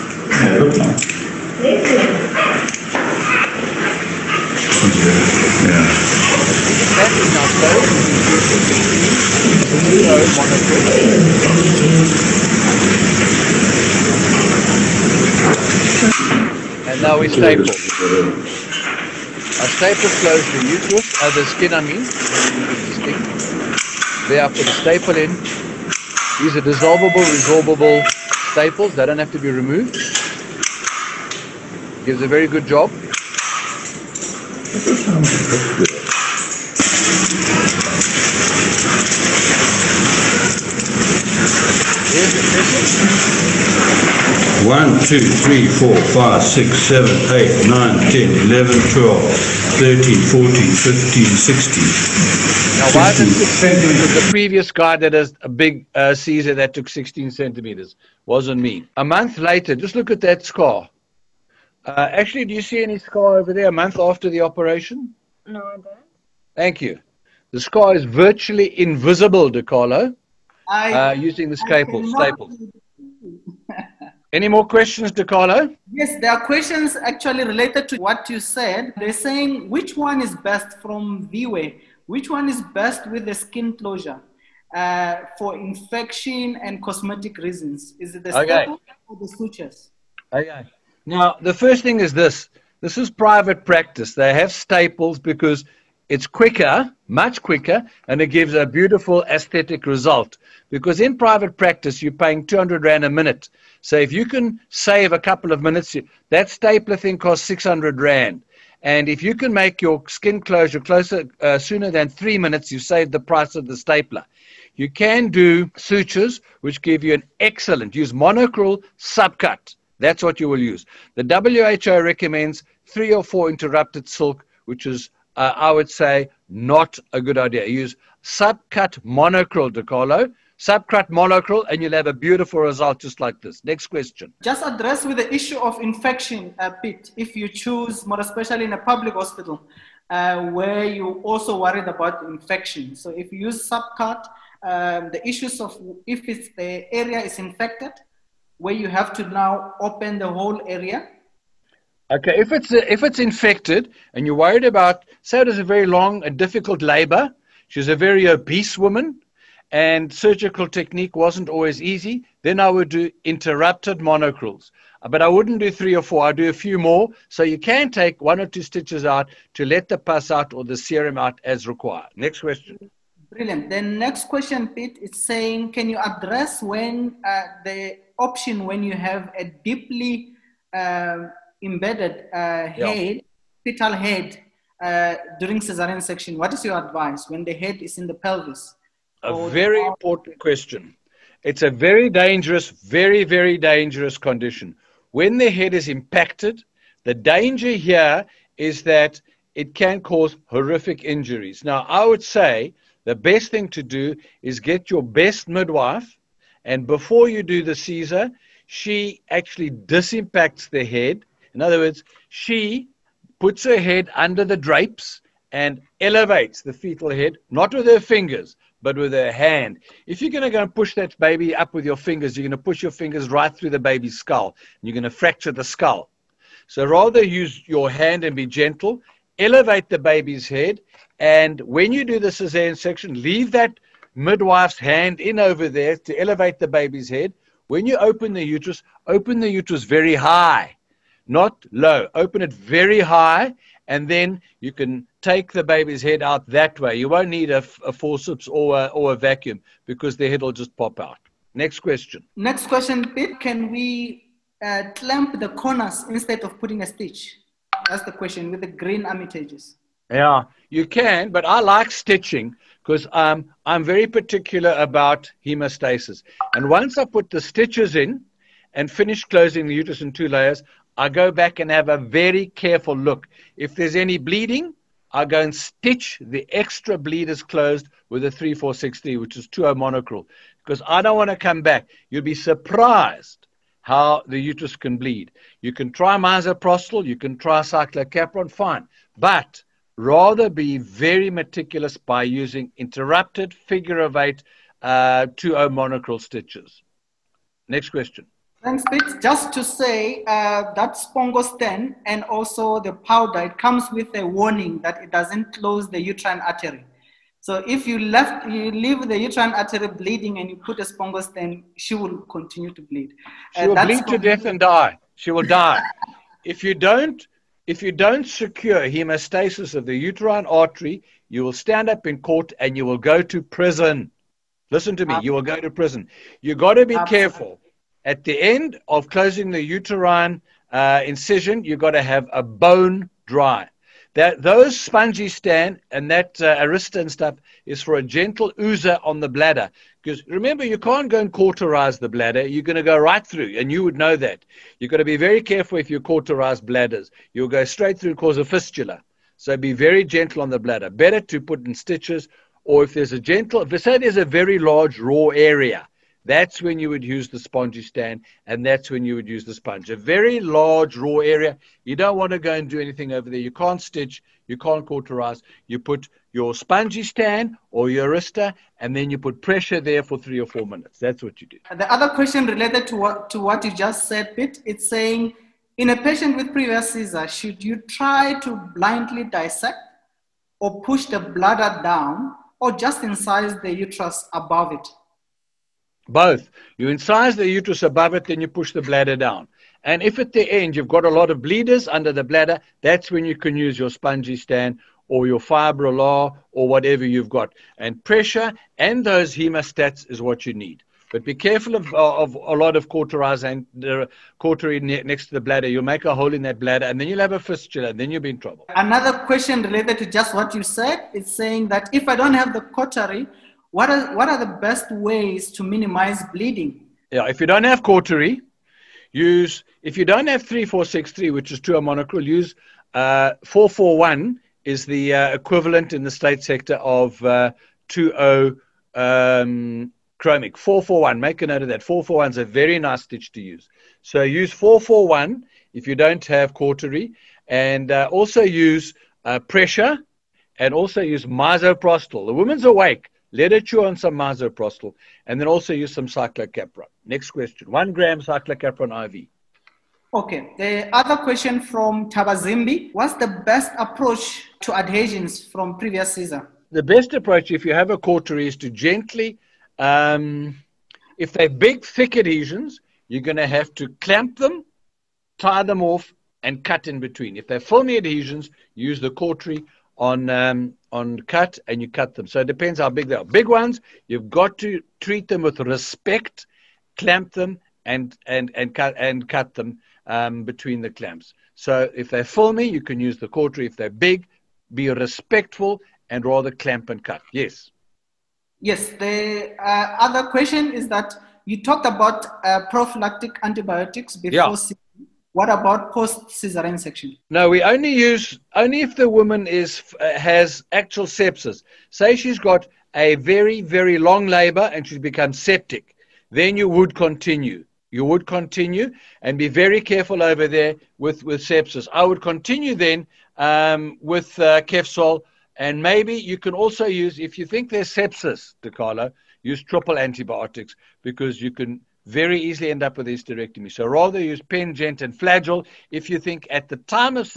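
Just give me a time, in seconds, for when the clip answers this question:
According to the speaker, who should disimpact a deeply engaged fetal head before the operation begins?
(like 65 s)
205 s.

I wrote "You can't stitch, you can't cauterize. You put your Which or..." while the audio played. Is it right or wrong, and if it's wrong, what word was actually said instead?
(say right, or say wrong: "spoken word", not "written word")
wrong: "Spongostan", not "Which".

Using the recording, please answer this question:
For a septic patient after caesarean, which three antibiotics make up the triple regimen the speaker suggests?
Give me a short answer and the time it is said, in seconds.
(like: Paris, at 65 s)
Pen, gent and Flagyl, at 524 s.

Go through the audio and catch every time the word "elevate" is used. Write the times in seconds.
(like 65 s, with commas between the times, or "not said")
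215 s, 229 s, 236 s.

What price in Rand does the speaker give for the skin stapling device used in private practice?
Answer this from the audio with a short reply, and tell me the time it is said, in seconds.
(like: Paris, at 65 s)
600 Rand, at 107 s.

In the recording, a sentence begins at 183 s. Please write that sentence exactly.
fetal head uh, during cesarean section.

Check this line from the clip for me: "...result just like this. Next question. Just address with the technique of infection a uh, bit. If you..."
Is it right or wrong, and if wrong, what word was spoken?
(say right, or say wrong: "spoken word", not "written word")
wrong: "issue", not "technique".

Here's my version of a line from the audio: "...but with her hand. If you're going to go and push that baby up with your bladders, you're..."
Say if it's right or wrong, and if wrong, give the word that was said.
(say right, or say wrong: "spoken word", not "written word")
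wrong: "fingers", not "bladders".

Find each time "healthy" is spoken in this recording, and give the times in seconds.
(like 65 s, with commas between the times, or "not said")
not said.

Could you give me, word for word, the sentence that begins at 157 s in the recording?
She's a very obese woman, and surgical technique wasn't always easy.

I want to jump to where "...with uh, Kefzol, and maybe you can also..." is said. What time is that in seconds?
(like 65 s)
514 s.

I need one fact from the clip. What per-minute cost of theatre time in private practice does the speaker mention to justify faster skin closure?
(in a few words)
200 Rand.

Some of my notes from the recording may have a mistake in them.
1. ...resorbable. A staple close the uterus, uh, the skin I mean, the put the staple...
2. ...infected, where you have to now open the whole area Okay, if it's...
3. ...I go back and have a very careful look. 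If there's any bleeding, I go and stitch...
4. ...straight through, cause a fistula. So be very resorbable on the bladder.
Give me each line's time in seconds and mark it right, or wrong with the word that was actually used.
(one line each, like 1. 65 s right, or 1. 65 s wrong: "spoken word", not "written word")
1. 17 s wrong: "staple", not "resorbable"
2. 147 s right
3. 270 s right
4. 347 s wrong: "gentle", not "resorbable".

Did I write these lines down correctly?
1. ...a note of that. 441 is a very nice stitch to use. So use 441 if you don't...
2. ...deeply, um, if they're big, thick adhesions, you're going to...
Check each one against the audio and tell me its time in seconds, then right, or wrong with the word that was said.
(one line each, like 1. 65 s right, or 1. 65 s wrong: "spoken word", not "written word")
1. 431 s right
2. 458 s wrong: "gently", not "deeply".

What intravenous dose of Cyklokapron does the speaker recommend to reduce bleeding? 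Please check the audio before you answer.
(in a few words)
1 gram.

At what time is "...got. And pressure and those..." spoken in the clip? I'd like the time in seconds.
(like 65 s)
397 s.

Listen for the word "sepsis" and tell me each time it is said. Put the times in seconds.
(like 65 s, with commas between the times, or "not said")
501 s, 511 s, 517 s.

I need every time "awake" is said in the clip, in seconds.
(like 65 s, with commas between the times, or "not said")
442 s.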